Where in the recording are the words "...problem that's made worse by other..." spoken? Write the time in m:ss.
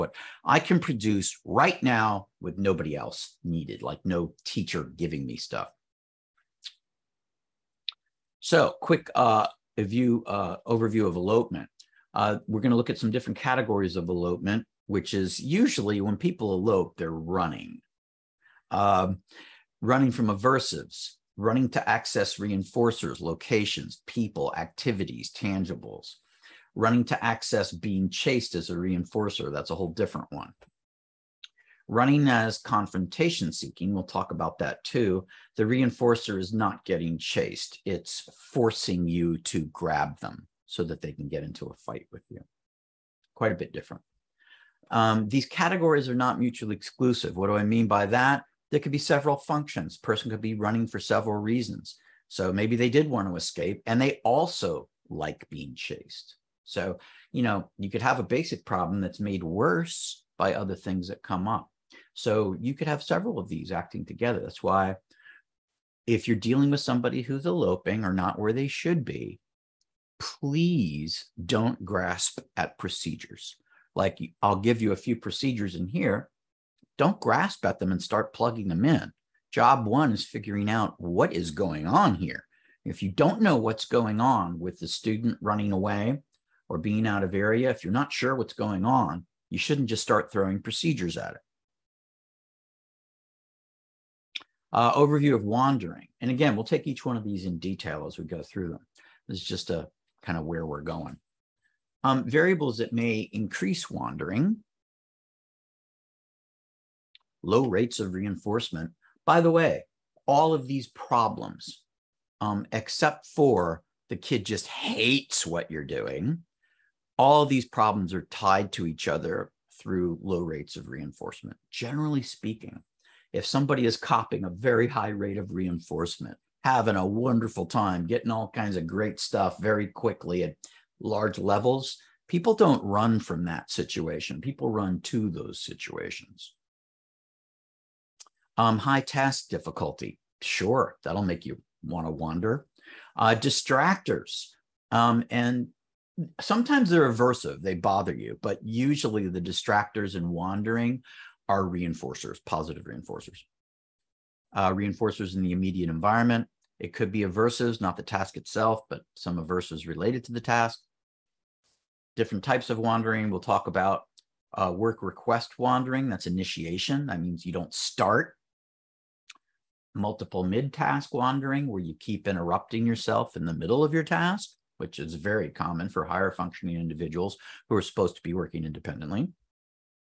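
0:58.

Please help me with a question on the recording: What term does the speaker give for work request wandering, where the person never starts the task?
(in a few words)
Initiation.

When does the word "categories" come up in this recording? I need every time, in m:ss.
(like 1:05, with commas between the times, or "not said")
0:13, 0:45.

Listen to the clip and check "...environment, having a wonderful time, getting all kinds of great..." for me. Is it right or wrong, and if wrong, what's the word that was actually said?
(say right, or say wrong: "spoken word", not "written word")
wrong: "reinforcement", not "environment".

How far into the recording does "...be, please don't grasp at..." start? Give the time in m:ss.
1:09.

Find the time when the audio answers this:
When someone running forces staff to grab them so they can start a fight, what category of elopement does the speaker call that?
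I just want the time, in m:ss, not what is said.
0:32.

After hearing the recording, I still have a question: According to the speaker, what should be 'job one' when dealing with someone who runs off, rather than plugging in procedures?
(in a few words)
Figuring out what is going on.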